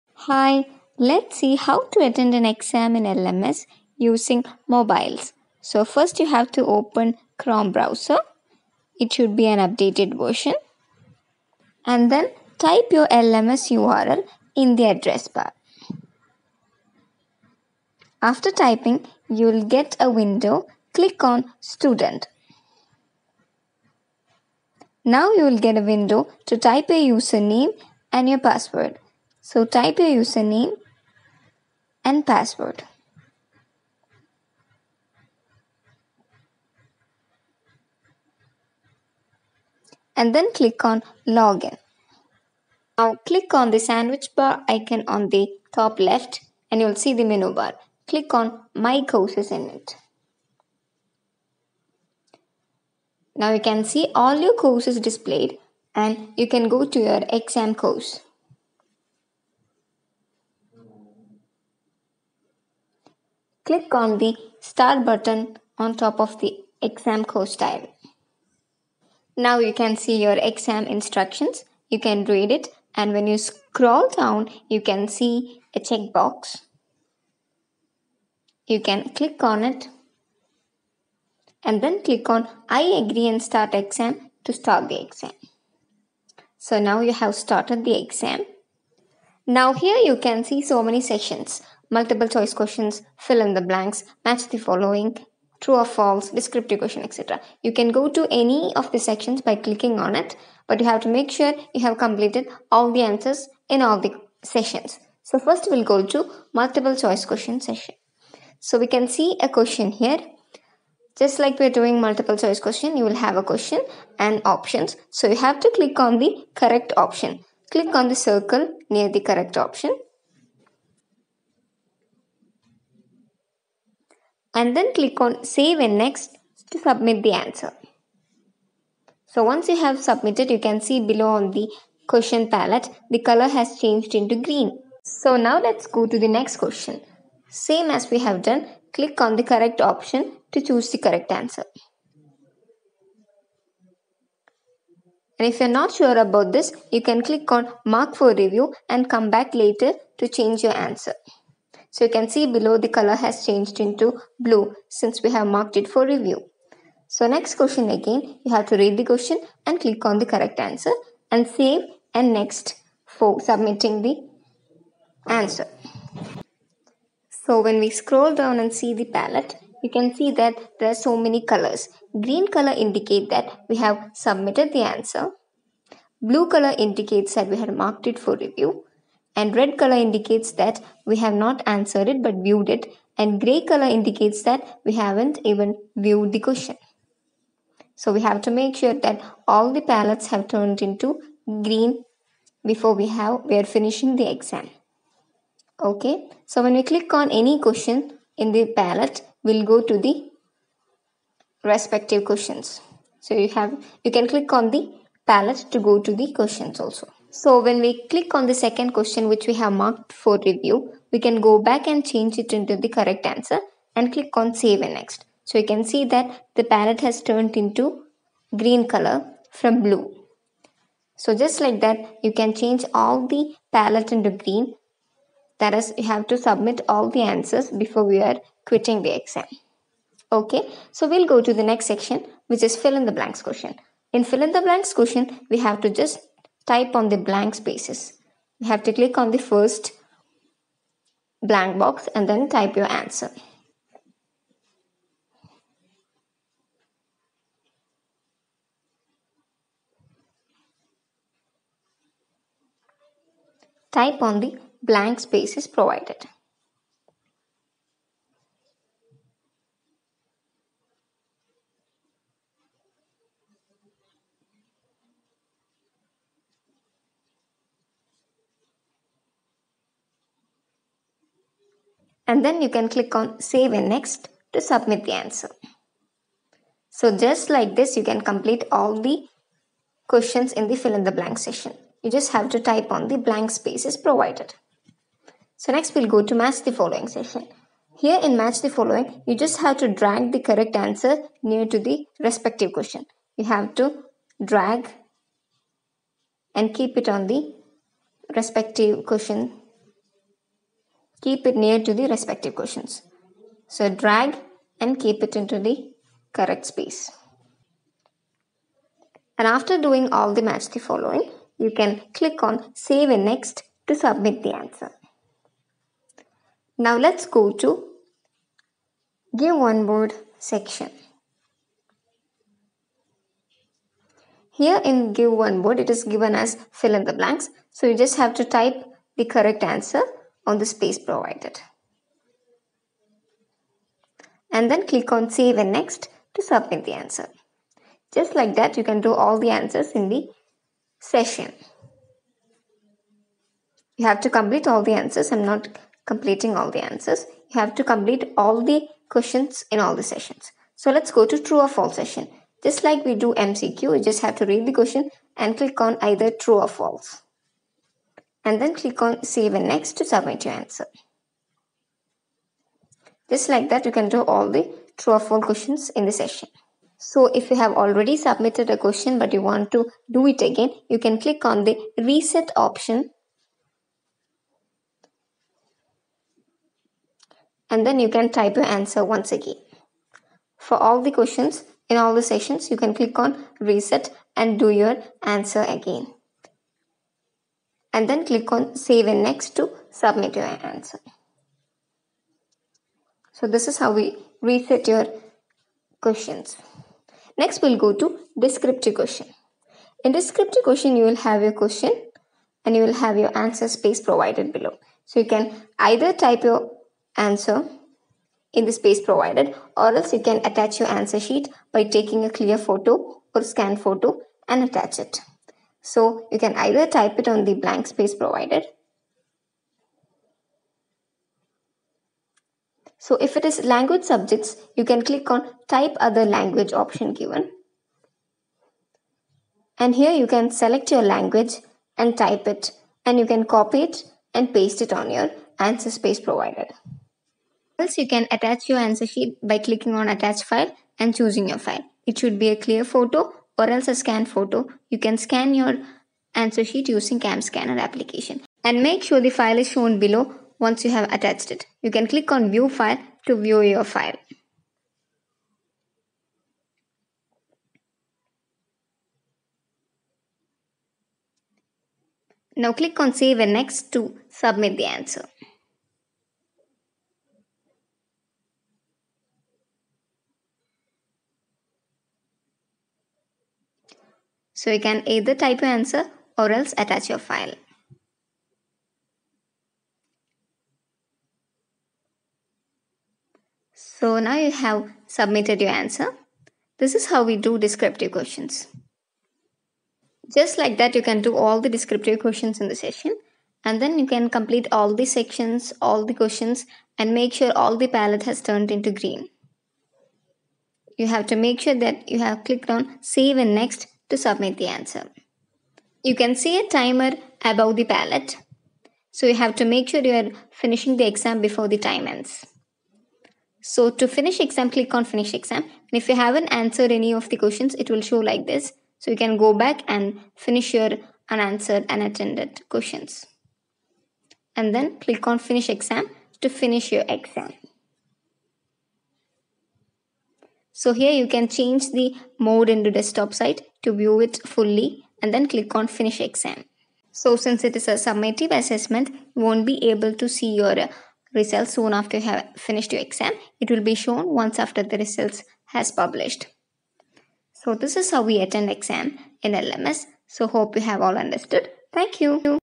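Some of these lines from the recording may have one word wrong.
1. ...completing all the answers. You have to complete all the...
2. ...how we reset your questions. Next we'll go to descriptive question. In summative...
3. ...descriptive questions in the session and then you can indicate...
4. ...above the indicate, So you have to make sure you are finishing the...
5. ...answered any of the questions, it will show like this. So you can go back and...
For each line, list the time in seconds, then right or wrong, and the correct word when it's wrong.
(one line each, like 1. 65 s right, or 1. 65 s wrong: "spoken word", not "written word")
1. 346 s right
2. 393 s wrong: "descriptive", not "summative"
3. 491 s wrong: "complete", not "indicate"
4. 507 s wrong: "palette", not "indicate"
5. 516 s right.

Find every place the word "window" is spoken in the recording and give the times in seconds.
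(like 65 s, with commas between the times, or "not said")
20 s, 25 s.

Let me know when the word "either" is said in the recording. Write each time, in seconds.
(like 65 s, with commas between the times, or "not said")
356 s, 405 s, 416 s, 475 s.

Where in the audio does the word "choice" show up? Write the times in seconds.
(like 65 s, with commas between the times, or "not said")
92 s, 106 s, 112 s.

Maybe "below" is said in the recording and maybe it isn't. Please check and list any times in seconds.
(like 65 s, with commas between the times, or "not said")
131 s, 152 s, 404 s, 449 s.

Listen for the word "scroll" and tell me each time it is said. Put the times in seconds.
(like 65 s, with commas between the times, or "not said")
73 s, 167 s.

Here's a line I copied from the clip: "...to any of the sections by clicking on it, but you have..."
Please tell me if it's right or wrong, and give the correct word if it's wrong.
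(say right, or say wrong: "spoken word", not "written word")
right.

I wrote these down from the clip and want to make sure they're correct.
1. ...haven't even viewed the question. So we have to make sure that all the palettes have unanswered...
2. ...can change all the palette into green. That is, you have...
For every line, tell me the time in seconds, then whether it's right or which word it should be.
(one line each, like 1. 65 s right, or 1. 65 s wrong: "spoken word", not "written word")
1. 184 s wrong: "turned", not "unanswered"
2. 222 s right.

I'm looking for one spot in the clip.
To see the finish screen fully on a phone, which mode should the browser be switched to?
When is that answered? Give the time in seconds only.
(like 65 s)
532 s.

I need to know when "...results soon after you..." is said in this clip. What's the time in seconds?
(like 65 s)
541 s.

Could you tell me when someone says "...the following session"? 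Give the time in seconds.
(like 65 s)
286 s.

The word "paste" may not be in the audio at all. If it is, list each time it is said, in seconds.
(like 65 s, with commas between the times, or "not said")
434 s.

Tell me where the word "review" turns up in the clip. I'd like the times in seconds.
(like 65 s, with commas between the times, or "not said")
148 s, 156 s, 178 s, 210 s.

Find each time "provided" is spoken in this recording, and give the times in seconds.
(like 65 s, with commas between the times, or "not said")
255 s, 284 s, 330 s, 403 s, 409 s, 418 s, 436 s.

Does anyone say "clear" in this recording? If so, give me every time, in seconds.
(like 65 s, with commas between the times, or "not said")
412 s, 442 s.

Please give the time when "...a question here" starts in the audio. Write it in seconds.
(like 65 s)
109 s.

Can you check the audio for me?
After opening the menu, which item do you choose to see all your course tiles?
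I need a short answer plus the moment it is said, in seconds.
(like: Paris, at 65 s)
My courses, at 48 s.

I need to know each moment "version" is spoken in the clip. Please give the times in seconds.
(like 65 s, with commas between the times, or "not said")
10 s.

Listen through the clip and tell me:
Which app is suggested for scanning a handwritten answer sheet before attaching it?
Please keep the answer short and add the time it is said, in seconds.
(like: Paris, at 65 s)
CamScanner, at 447 s.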